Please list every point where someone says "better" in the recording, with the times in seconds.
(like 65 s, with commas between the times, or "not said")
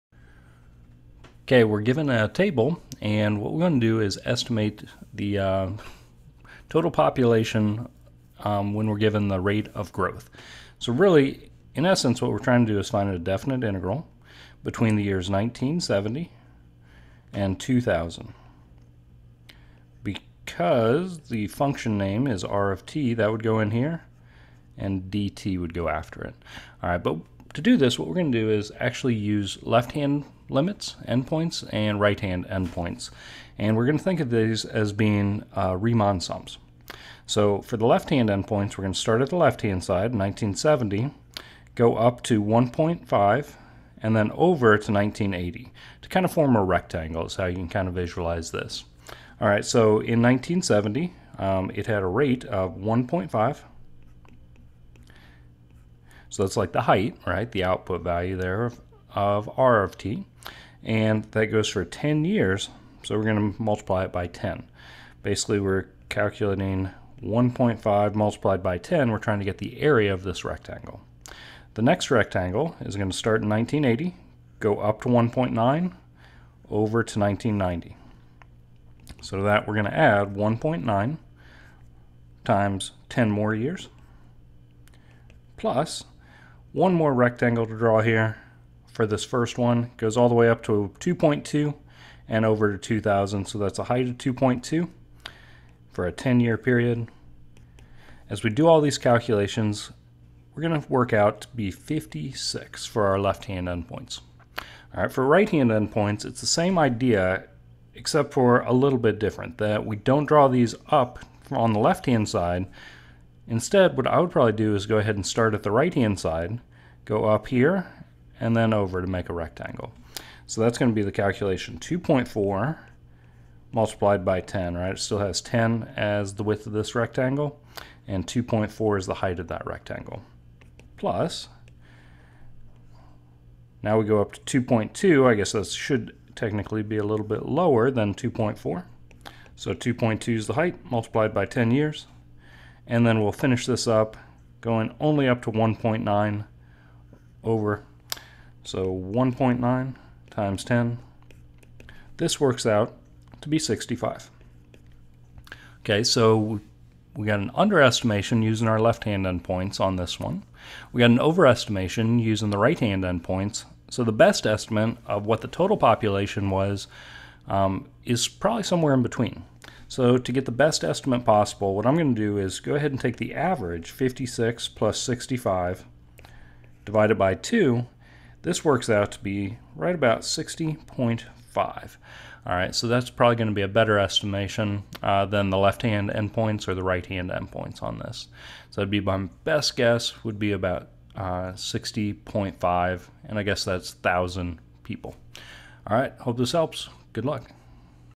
183 s.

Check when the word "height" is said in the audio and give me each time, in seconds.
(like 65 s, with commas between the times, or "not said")
56 s, 93 s, 129 s, 140 s.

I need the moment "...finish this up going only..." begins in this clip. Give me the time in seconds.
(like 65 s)
143 s.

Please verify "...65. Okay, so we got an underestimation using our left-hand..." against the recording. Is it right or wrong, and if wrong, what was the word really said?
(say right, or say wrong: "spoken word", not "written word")
right.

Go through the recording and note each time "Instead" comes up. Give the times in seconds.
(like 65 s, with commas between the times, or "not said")
113 s.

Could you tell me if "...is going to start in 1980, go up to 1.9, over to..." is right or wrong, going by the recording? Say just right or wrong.
right.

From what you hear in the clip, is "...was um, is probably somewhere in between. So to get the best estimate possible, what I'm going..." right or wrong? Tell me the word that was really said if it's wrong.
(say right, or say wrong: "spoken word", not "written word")
right.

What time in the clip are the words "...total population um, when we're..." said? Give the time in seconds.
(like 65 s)
6 s.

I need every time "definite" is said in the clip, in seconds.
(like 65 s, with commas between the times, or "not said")
13 s.